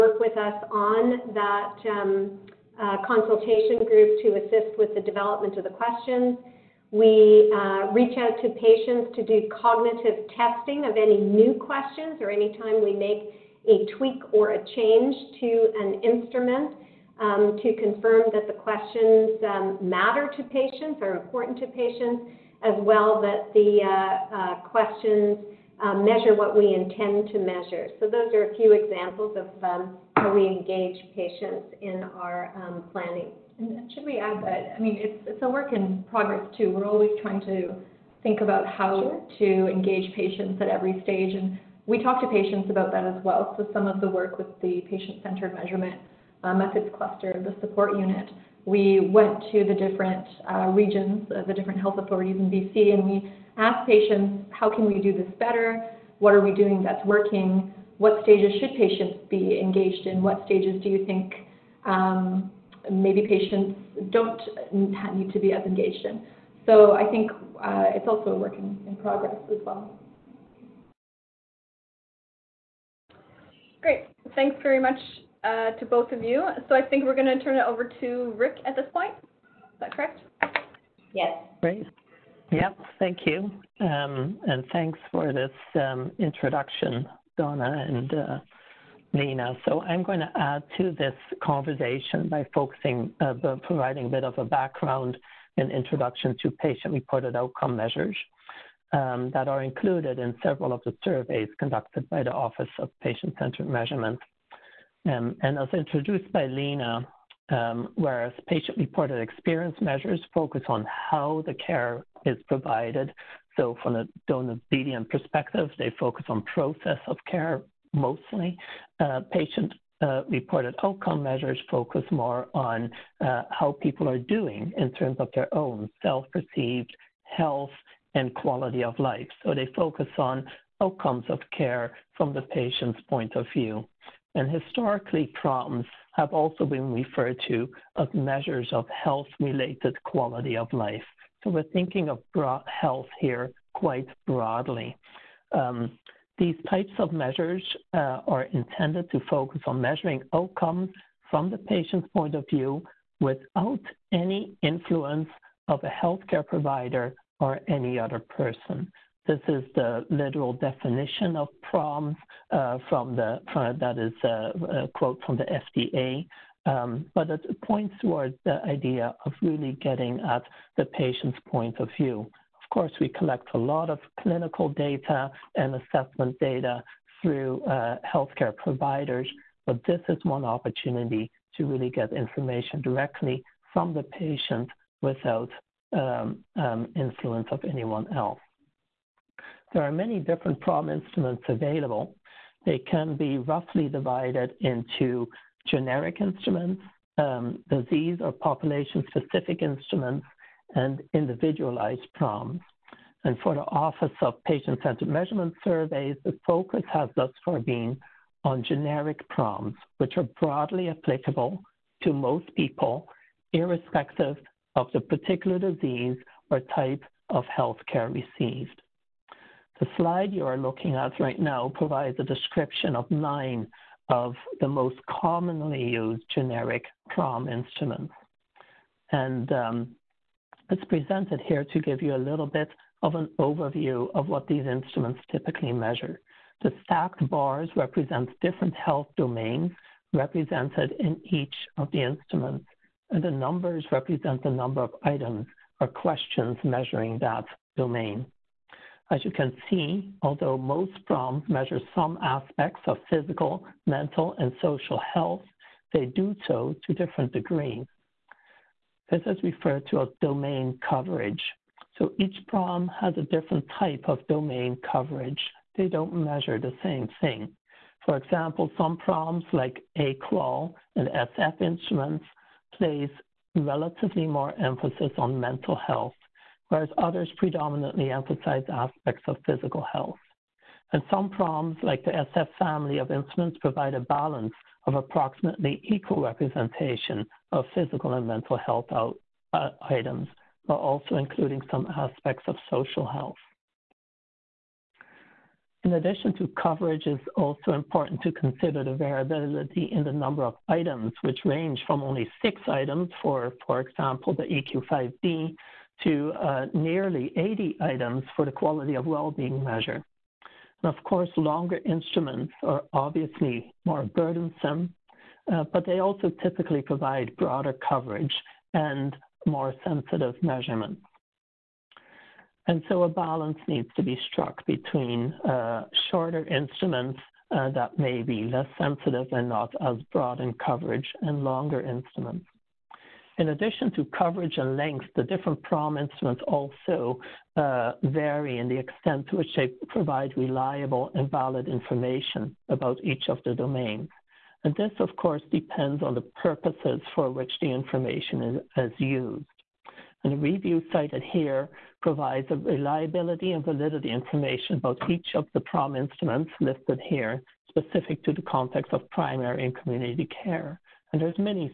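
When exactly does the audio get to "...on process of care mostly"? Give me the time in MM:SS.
01:56.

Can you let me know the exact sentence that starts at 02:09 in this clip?
So they focus on outcomes of care from the patient's point of view.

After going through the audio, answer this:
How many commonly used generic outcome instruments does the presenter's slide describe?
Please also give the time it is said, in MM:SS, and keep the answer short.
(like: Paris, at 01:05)
9, at 03:43.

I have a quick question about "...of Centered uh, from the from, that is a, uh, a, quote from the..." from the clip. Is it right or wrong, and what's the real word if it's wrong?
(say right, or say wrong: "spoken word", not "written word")
wrong: "PROMs", not "Centered".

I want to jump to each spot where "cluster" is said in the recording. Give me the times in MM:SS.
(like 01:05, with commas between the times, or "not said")
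00:46.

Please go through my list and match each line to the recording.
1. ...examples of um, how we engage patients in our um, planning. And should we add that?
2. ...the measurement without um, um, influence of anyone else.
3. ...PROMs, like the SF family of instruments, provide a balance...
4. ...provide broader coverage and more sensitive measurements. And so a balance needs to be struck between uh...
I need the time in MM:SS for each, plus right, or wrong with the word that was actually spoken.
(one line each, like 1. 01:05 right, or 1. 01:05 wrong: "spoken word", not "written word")
1. 00:28 right
2. 03:03 wrong: "patient", not "measurement"
3. 04:41 right
4. 05:16 right.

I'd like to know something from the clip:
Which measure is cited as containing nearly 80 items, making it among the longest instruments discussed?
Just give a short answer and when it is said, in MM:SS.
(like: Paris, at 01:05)
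quality of well-being measure, at 05:08.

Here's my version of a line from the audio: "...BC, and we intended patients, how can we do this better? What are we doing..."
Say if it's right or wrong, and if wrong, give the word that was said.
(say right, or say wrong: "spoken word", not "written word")
wrong: "asked", not "intended".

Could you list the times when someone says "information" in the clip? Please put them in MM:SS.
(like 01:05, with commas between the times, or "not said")
03:02, 05:41, 05:47, 05:54.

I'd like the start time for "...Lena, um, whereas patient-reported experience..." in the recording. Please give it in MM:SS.
01:46.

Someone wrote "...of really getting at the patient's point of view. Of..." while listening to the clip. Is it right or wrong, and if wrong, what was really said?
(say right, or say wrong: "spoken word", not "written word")
right.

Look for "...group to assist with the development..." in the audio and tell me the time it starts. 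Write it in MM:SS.
00:03.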